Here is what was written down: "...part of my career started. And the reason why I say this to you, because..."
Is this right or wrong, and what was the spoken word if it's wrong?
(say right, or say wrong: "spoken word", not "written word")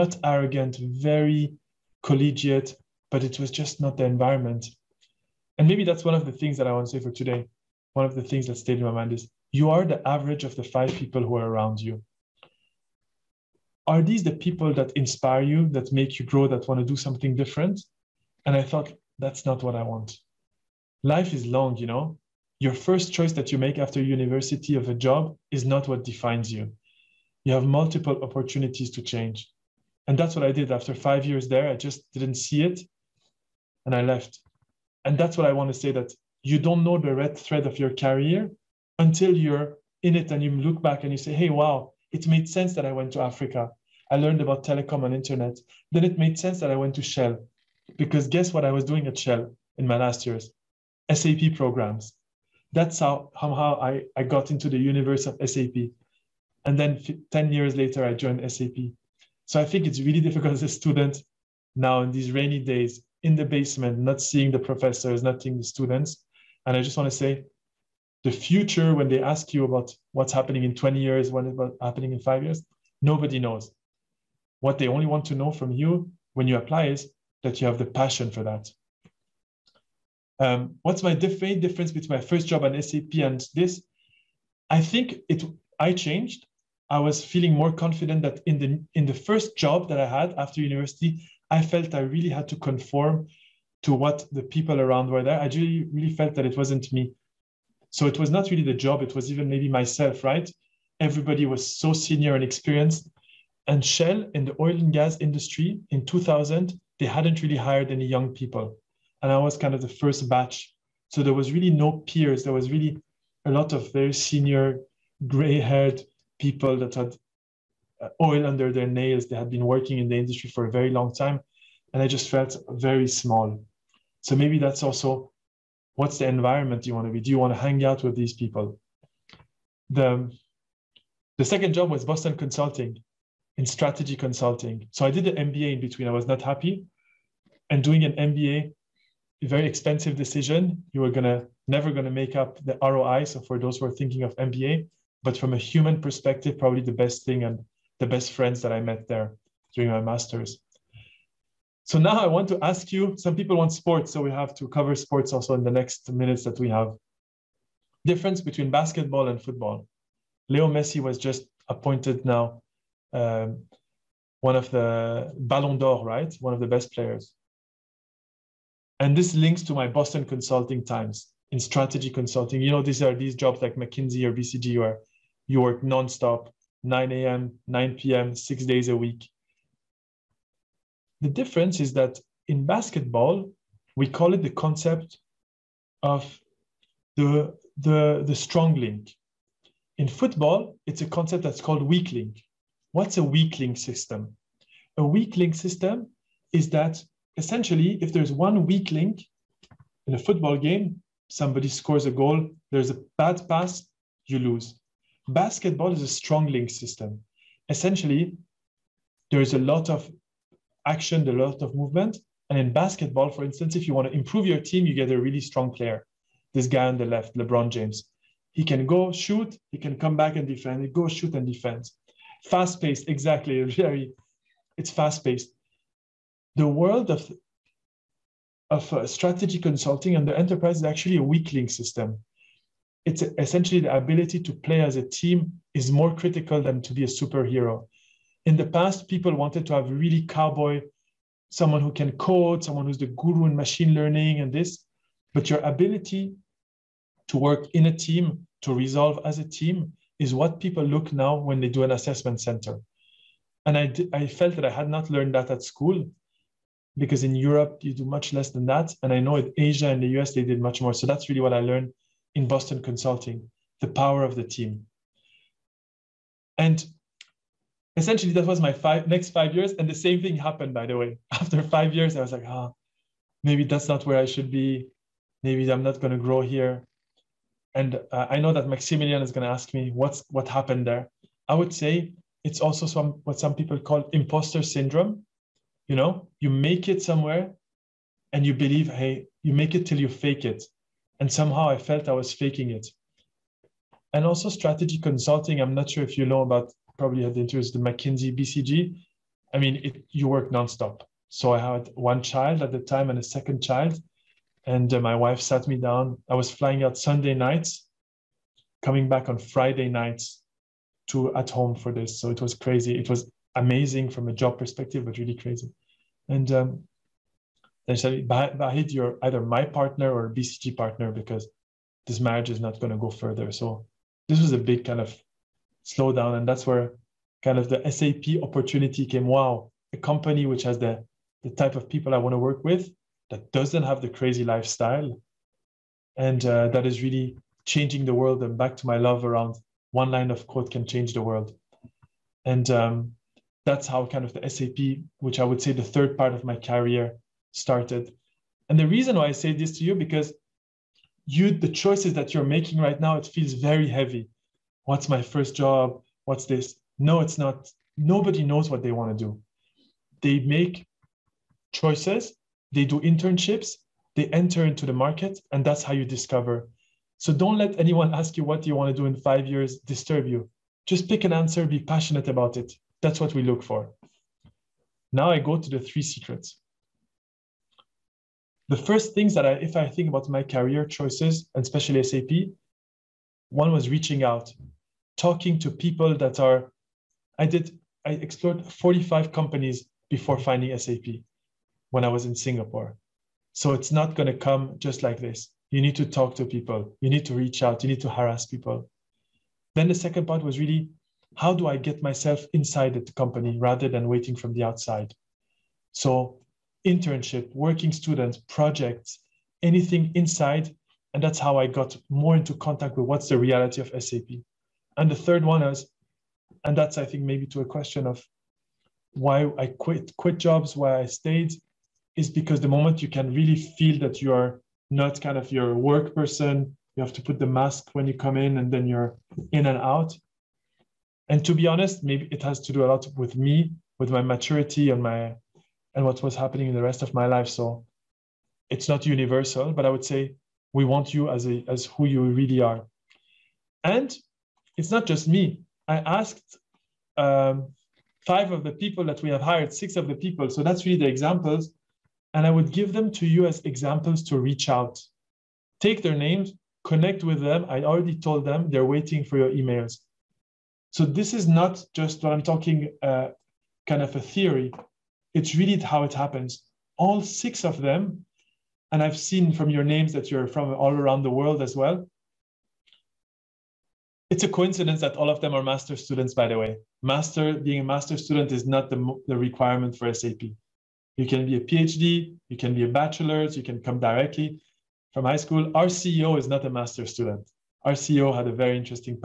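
right.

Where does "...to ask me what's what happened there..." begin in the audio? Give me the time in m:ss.
4:39.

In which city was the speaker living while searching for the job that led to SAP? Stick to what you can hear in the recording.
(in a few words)
Singapore.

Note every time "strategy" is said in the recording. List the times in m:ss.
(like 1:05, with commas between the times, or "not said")
2:13, 2:51, 3:49, 4:54.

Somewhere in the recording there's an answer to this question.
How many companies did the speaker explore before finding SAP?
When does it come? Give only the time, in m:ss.
6:28.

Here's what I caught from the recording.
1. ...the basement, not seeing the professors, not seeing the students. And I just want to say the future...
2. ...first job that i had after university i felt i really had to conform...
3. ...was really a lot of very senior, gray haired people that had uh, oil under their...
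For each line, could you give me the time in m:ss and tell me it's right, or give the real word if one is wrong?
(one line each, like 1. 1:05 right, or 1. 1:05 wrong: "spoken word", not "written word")
1. 1:03 right
2. 1:29 right
3. 1:52 right.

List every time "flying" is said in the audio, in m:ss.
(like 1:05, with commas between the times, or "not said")
5:06.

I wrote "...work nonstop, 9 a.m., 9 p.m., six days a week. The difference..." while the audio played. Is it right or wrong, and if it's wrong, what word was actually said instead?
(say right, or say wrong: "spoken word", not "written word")
right.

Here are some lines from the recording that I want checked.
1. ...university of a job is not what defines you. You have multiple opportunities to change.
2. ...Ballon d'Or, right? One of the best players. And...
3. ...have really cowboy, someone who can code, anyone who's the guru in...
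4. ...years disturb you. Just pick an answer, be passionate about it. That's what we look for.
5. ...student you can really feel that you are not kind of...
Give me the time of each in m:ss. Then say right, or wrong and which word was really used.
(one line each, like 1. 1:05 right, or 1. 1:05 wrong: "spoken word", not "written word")
1. 0:24 right
2. 2:45 right
3. 3:59 wrong: "someone", not "anyone"
4. 6:09 right
5. 7:02 wrong: "moment", not "student".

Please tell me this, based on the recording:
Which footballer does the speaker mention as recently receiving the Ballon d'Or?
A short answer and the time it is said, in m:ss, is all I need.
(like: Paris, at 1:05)
Leo Messi, at 2:40.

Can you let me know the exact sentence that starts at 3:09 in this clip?
In football, it's a concept that's called weak link.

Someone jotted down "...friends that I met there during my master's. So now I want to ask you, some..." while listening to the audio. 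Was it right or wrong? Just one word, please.
right.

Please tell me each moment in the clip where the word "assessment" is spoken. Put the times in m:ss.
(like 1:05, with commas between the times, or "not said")
4:11.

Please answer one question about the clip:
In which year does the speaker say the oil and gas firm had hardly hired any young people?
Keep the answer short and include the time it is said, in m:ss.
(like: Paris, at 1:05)
2000, at 1:46.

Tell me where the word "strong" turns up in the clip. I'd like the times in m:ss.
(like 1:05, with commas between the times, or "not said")
3:08, 3:26, 3:35.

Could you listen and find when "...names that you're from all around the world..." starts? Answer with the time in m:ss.
7:49.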